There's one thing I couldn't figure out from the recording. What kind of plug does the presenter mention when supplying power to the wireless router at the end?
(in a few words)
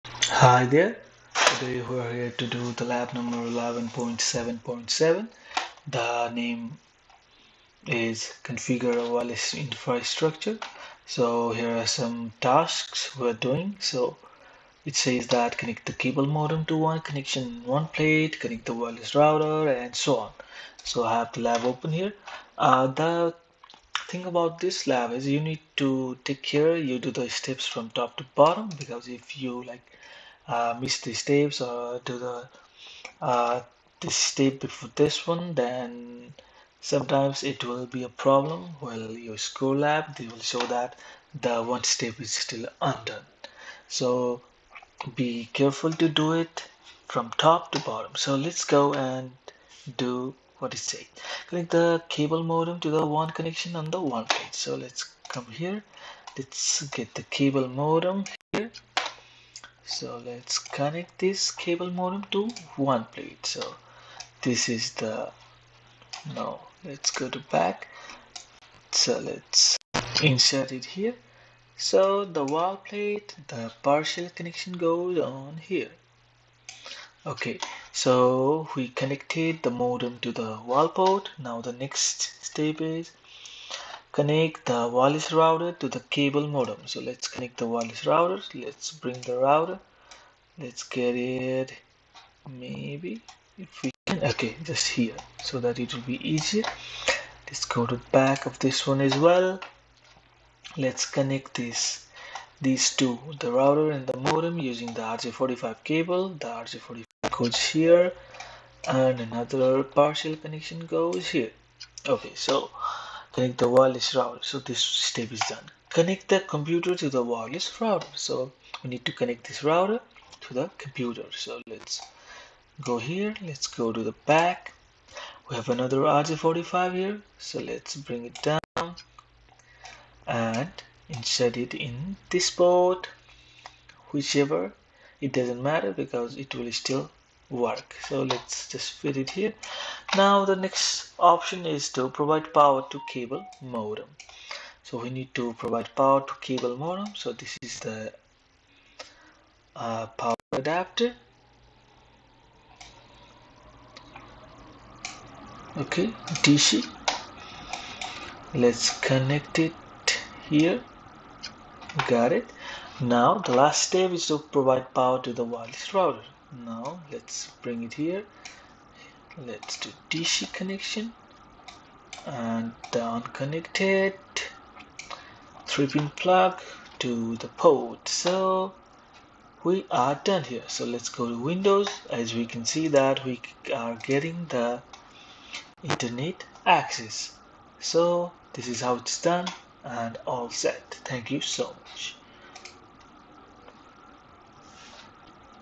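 3 pin plug.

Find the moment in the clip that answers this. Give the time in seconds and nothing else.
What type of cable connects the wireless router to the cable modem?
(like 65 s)
105 s.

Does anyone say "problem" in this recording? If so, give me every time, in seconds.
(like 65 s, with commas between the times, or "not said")
38 s.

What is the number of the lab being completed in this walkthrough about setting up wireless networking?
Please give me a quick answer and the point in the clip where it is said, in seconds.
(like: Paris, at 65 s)
11.7.7, at 3 s.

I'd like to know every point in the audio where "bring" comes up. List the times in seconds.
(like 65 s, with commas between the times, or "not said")
88 s, 127 s, 167 s.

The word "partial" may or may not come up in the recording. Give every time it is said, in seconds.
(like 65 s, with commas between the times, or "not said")
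73 s, 109 s.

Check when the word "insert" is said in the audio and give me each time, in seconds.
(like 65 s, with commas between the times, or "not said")
70 s, 131 s.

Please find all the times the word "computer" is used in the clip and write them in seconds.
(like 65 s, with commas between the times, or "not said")
116 s, 120 s.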